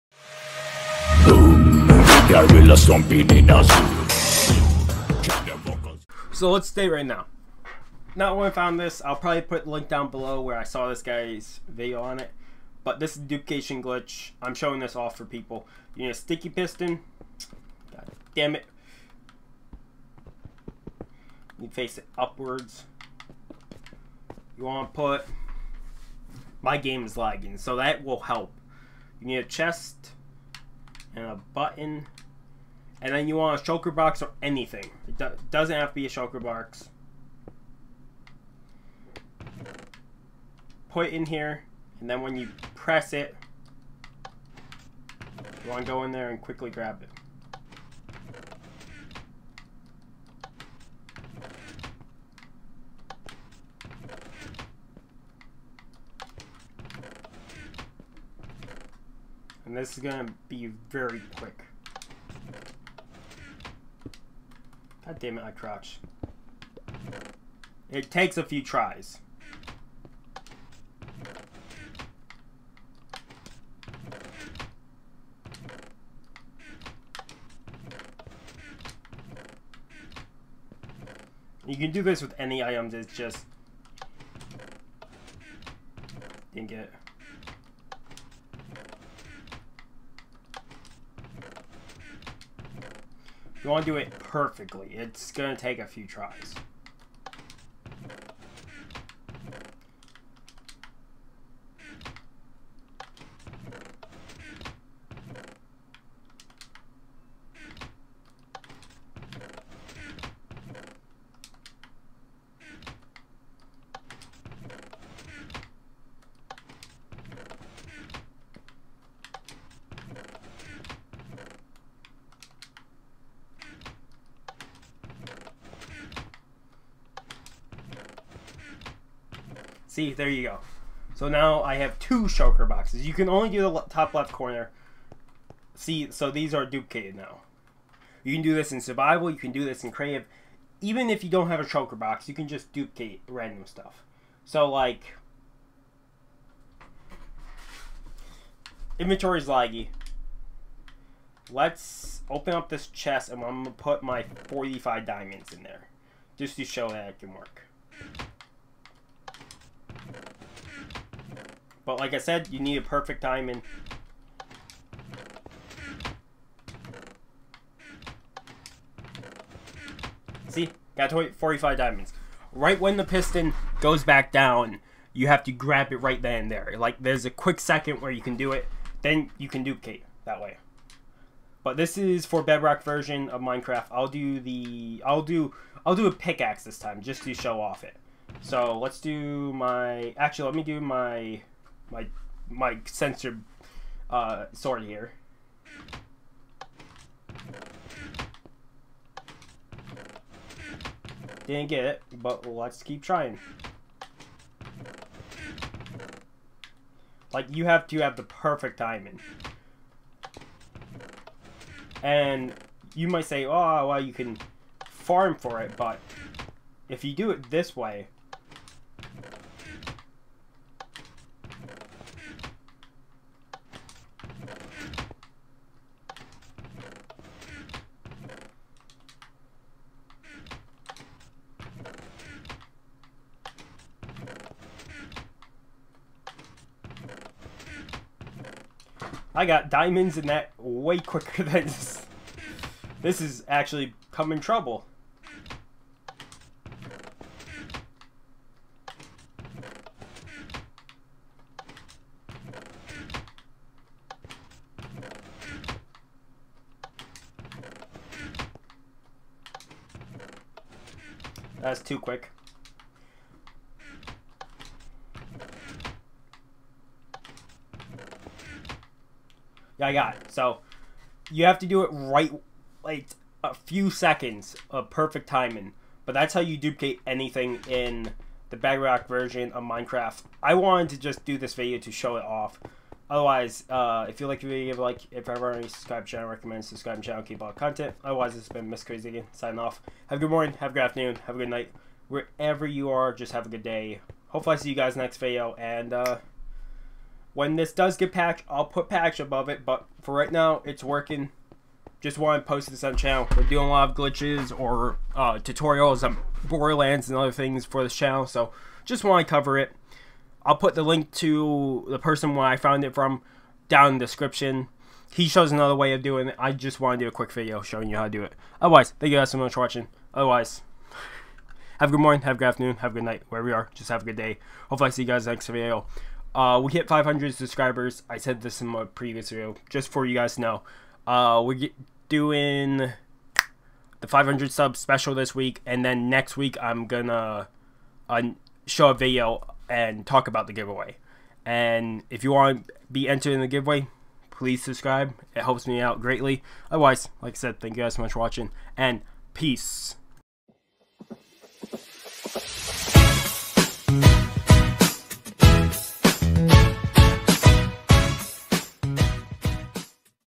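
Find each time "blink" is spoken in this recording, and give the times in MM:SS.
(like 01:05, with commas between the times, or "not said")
not said.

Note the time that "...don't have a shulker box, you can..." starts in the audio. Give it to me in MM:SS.
02:21.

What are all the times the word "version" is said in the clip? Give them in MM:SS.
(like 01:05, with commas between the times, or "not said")
03:02, 04:39.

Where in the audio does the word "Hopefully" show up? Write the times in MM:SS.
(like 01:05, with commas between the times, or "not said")
04:54, 05:24.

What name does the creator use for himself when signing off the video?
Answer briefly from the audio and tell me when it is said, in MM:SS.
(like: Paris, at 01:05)
Mr. Crazy Deakon, at 04:48.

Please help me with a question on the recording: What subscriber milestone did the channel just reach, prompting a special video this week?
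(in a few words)
500.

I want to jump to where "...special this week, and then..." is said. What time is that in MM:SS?
05:34.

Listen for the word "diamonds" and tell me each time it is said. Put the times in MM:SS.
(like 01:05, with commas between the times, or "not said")
02:35, 02:43, 02:51, 03:28, 03:59.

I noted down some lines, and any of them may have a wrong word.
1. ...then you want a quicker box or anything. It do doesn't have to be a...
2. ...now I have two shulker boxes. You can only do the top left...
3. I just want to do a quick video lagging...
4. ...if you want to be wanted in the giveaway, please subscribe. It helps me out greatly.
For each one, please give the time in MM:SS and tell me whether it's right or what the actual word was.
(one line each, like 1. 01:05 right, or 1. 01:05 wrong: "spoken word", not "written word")
1. 00:33 wrong: "shulker", not "quicker"
2. 02:11 right
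3. 05:16 wrong: "showing", not "lagging"
4. 05:42 wrong: "entered", not "wanted".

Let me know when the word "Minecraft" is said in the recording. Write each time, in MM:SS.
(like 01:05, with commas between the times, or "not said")
03:03, 04:39.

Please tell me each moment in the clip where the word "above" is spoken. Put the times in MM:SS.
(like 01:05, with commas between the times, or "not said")
04:59.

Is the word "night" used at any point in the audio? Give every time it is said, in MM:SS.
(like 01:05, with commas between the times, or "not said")
04:51, 05:23.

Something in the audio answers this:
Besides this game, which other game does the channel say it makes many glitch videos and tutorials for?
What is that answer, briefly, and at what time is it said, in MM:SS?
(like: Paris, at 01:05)
Borderlands, at 05:06.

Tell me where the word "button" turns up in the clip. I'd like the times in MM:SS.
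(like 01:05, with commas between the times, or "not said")
00:31.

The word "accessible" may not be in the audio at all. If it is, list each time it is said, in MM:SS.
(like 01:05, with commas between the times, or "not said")
not said.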